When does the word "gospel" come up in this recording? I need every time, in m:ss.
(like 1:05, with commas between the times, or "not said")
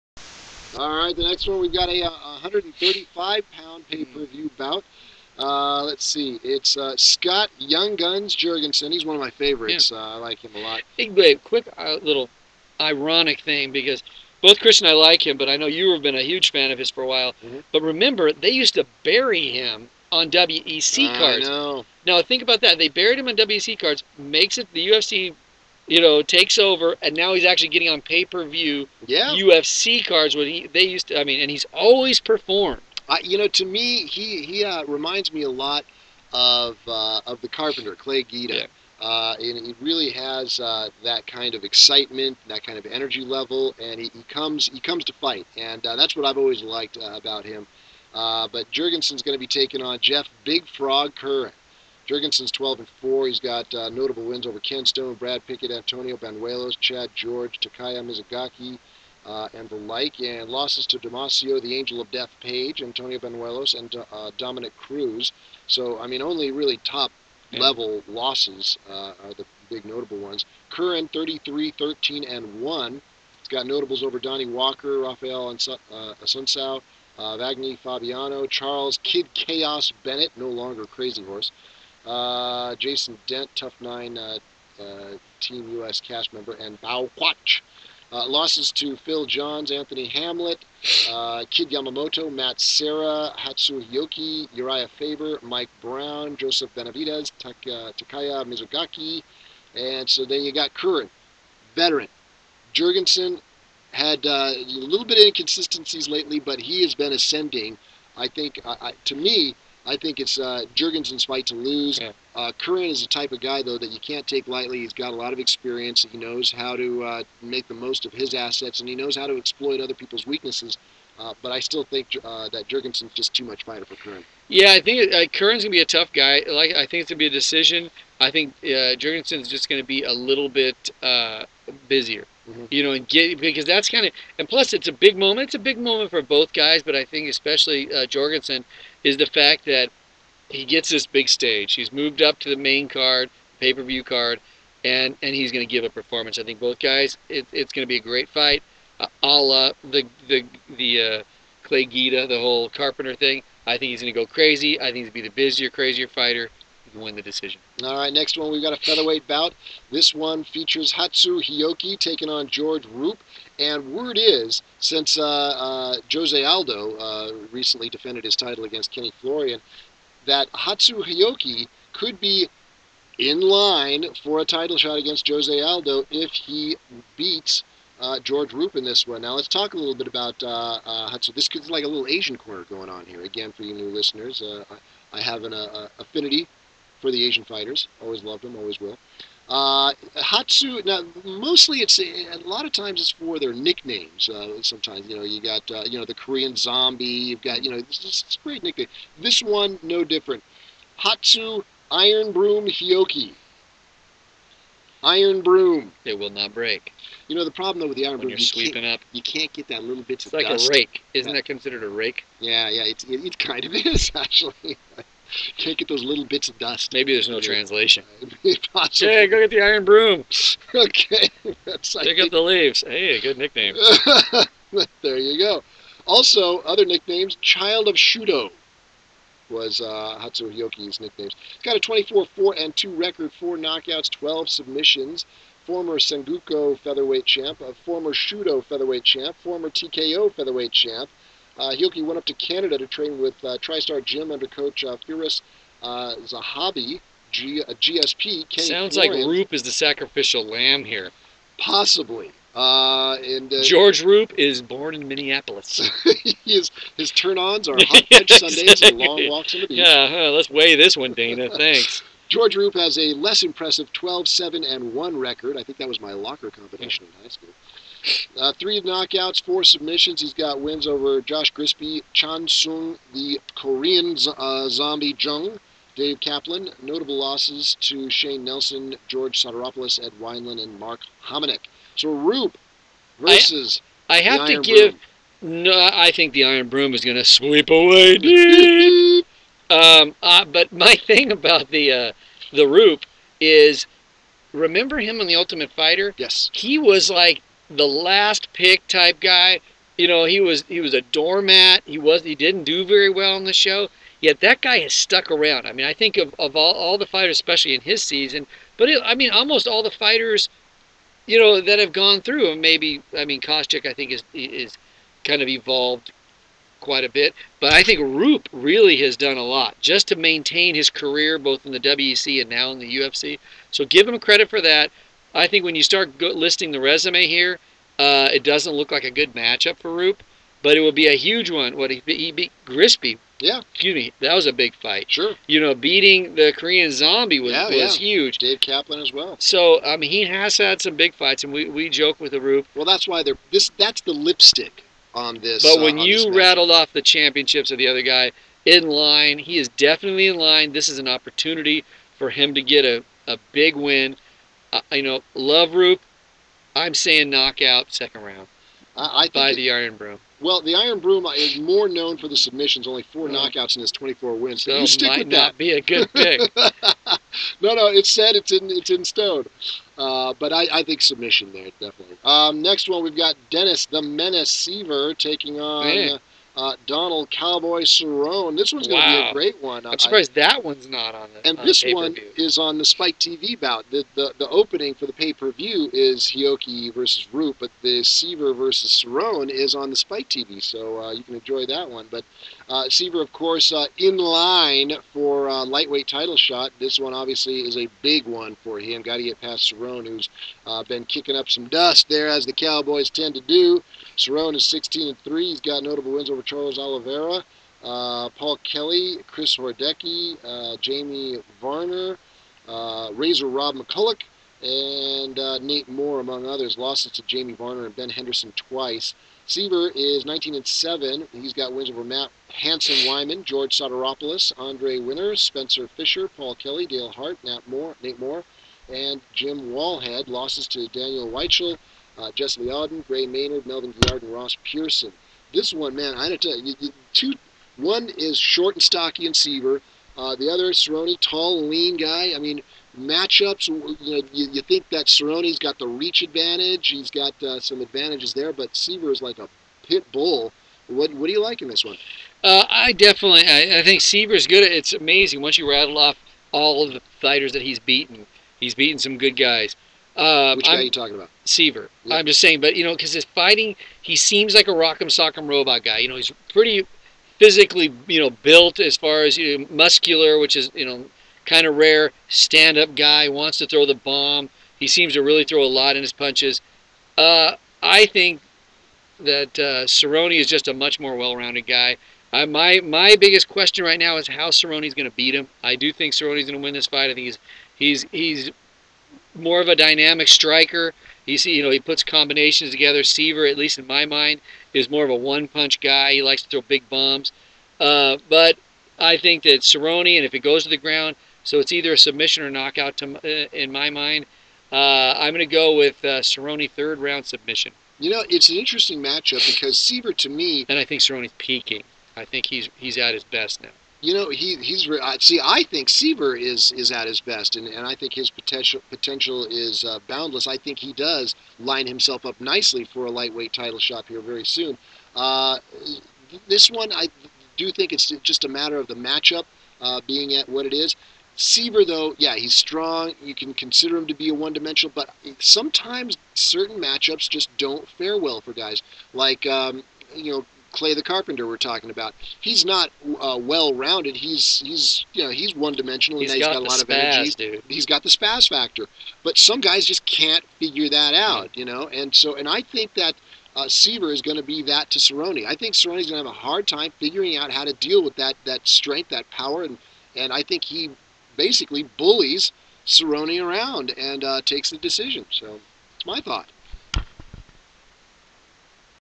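not said.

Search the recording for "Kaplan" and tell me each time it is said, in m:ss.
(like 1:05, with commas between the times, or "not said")
4:36, 5:38.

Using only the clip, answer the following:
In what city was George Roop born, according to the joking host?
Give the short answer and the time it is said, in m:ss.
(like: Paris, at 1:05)
Minneapolis, at 4:15.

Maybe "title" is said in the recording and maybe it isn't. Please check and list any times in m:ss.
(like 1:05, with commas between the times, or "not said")
2:48, 2:54, 6:36, 8:43.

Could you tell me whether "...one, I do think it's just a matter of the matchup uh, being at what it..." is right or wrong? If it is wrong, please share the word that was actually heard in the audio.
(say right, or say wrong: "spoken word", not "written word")
right.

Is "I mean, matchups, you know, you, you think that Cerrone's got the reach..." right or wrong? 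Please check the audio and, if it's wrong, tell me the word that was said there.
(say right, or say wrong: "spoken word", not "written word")
right.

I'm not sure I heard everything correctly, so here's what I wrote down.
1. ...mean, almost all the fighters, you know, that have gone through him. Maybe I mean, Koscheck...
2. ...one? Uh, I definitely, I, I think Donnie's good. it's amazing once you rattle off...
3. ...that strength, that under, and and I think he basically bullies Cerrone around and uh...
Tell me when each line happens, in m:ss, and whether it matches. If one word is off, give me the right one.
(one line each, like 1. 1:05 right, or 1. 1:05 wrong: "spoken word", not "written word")
1. 5:09 right
2. 7:31 wrong: "Siver", not "Donnie"
3. 9:18 wrong: "power", not "under".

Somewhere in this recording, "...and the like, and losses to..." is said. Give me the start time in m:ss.
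0:59.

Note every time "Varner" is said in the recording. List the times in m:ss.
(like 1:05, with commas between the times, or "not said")
6:51, 6:57.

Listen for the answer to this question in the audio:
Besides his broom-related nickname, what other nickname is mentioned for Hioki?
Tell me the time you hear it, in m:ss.
3:47.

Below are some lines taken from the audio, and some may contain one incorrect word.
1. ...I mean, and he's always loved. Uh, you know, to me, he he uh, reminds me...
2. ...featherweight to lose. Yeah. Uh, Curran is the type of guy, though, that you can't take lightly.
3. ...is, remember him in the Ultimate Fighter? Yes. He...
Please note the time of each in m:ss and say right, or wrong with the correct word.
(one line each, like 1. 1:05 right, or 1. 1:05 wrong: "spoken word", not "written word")
1. 0:31 wrong: "performed", not "loved"
2. 1:51 wrong: "fight", not "featherweight"
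3. 4:53 right.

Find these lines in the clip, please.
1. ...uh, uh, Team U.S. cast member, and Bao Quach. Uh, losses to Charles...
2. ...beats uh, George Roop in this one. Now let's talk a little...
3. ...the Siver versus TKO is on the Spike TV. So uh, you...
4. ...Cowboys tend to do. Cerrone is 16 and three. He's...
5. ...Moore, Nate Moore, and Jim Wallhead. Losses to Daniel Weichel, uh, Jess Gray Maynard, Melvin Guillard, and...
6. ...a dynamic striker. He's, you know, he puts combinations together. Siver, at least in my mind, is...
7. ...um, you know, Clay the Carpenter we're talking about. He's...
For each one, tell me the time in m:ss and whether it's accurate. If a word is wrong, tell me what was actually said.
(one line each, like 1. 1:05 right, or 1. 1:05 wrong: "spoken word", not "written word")
1. 1:24 wrong: "Phil", not "Charles"
2. 2:57 right
3. 6:27 wrong: "Cerrone", not "TKO"
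4. 6:42 right
5. 7:07 right
6. 8:09 right
7. 8:59 right.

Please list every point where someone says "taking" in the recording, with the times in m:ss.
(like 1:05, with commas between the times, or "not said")
0:49, 2:41, 6:15.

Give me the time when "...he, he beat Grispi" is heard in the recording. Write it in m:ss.
5:31.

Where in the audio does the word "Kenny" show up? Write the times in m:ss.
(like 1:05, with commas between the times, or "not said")
2:48, 4:08.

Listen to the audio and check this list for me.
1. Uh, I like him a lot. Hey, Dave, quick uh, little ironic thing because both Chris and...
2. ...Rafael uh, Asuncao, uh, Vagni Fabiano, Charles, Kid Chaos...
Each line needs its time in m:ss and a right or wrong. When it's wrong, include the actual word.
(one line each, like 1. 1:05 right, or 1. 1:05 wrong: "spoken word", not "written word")
1. 0:09 right
2. 1:14 right.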